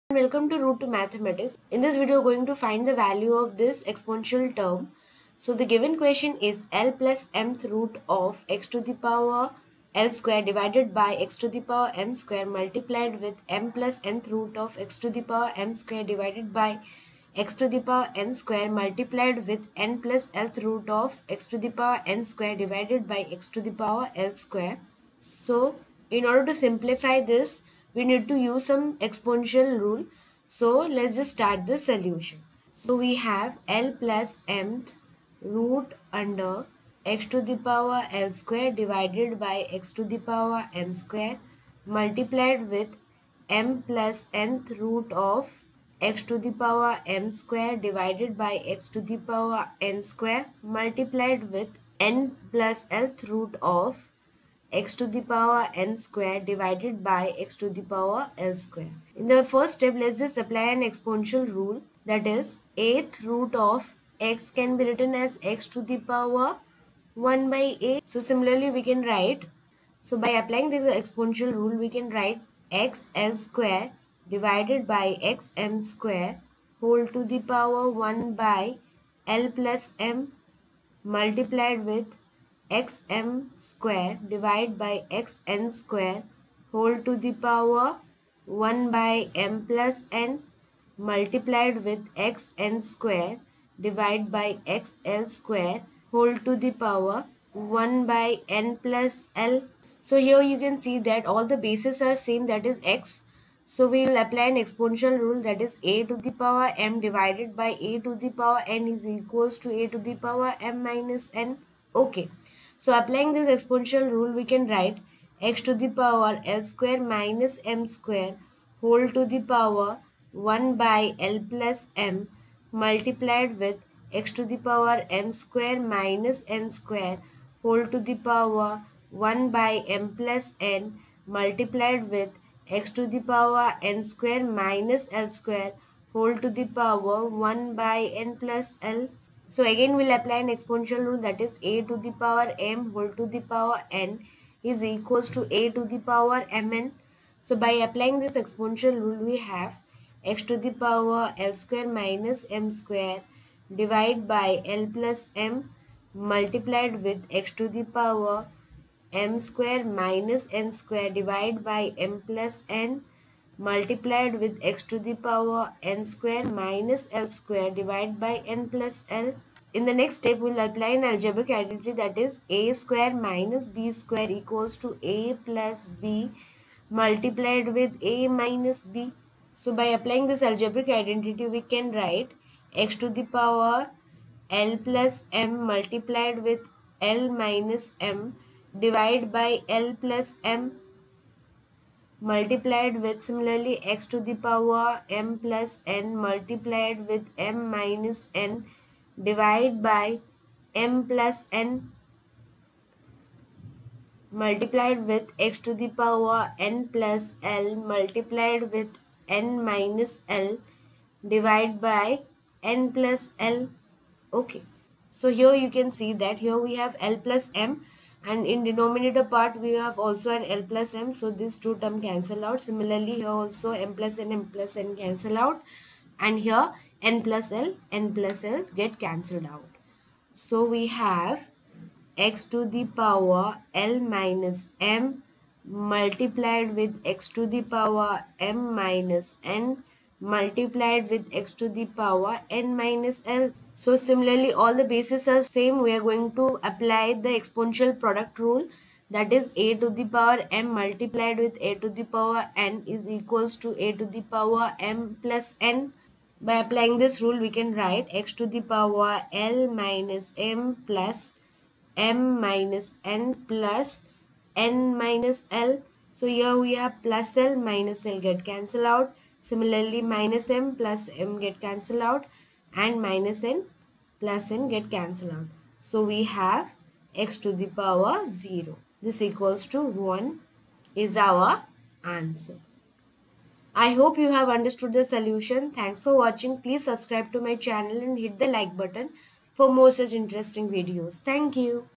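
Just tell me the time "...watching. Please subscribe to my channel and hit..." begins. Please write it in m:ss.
4:46.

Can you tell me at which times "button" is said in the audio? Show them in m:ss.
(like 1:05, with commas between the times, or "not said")
4:48.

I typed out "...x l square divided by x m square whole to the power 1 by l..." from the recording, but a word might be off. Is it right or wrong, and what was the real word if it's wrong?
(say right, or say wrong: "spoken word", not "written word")
right.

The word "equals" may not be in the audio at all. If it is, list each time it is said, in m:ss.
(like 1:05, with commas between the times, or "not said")
1:49, 2:24, 2:54, 4:13, 4:39.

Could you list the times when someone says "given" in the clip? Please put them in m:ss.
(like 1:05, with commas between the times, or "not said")
0:05.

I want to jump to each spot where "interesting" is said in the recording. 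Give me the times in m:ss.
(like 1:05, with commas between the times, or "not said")
4:50.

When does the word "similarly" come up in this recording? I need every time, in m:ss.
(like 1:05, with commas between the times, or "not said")
1:08, 3:13, 3:42, 4:03, 4:29.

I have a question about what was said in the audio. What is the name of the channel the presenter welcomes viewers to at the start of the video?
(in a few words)
Route to Mathematics.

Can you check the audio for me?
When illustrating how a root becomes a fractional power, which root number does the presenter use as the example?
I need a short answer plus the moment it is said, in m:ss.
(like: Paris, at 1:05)
8, at 1:02.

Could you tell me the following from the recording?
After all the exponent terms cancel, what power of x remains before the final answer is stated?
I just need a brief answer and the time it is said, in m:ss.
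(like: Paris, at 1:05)
0, at 4:37.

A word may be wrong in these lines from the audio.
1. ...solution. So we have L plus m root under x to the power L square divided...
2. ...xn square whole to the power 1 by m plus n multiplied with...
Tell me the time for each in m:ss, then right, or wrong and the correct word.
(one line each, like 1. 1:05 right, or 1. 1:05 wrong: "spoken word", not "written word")
1. 0:31 right
2. 1:25 right.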